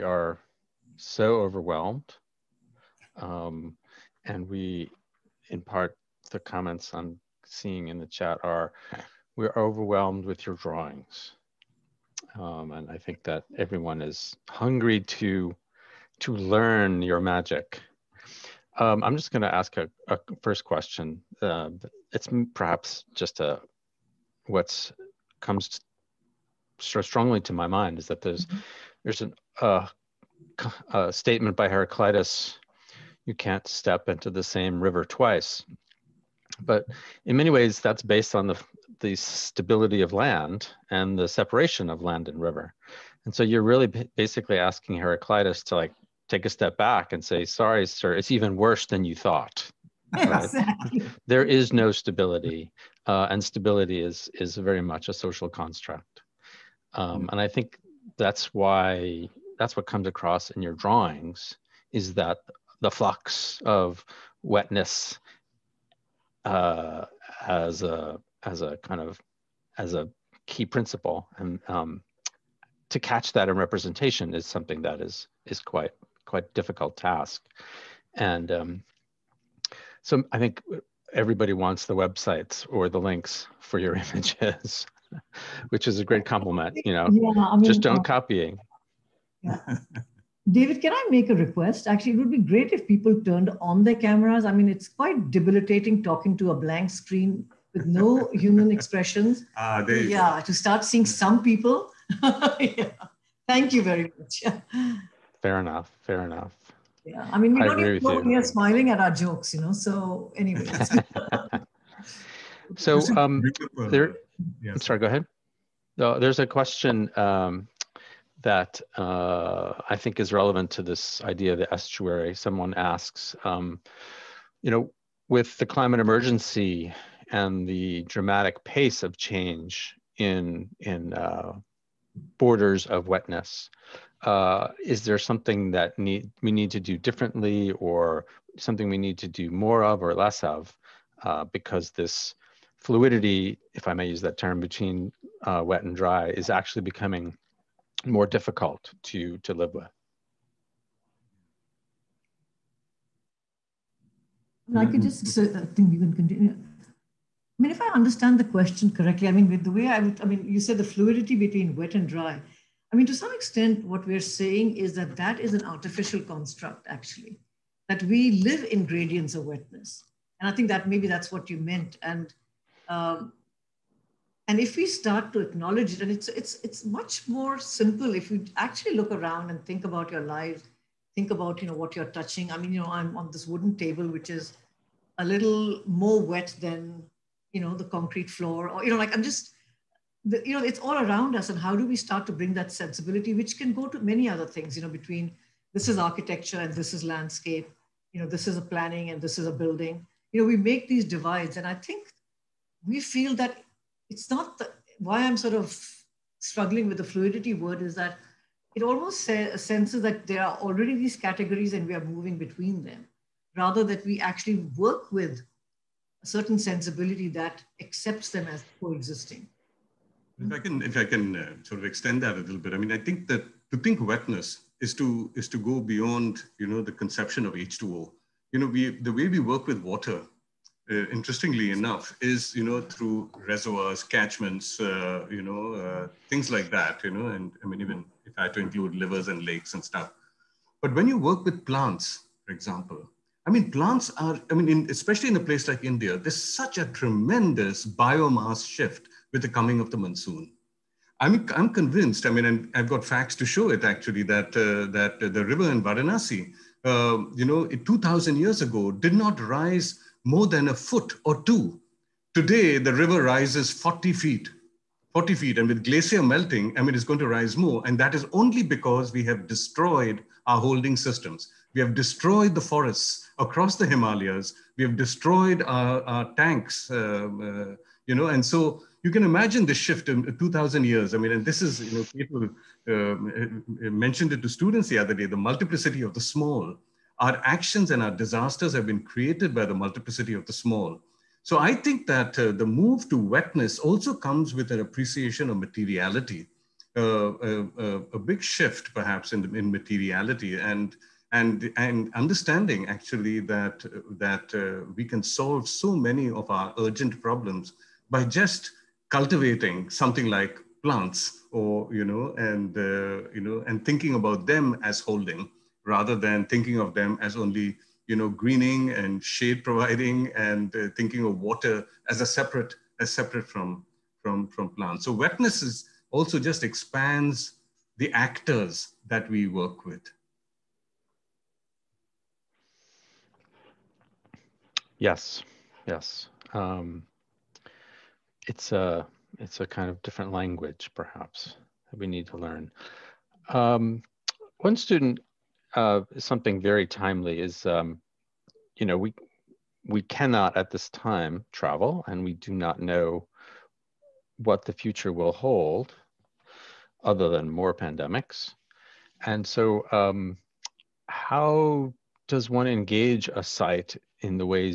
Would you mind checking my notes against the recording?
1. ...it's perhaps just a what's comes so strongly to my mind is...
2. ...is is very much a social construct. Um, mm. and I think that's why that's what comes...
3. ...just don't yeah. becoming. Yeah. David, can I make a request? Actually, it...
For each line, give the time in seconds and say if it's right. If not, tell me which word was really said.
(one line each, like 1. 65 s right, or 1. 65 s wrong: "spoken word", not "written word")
1. 22 s right
2. 54 s right
3. 87 s wrong: "copying", not "becoming".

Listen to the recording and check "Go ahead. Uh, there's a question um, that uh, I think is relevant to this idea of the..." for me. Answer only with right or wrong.
right.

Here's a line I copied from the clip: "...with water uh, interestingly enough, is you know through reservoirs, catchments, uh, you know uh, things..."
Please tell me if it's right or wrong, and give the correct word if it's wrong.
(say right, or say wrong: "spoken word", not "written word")
right.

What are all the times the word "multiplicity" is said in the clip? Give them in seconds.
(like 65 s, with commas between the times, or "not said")
285 s, 289 s.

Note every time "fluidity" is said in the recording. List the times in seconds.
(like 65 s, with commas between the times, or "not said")
142 s, 160 s, 207 s.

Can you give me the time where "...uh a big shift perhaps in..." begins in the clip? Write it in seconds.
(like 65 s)
297 s.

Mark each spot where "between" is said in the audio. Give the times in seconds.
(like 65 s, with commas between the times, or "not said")
144 s, 161 s, 194 s, 212 s.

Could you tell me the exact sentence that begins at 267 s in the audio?
And that is only because we have destroyed our holding systems.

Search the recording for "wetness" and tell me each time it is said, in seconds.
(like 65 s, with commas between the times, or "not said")
64 s, 133 s, 169 s, 224 s, 293 s, 325 s.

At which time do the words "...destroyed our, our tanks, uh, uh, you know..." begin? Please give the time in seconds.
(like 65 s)
274 s.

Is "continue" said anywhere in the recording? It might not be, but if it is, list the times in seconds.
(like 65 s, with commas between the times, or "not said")
156 s.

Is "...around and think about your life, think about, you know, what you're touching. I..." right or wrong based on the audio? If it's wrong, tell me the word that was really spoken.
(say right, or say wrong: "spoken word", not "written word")
right.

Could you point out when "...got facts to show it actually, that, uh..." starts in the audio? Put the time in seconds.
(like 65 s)
252 s.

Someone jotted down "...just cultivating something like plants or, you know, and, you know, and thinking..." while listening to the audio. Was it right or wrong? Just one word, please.
right.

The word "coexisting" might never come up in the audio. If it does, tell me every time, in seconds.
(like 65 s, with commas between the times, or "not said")
218 s.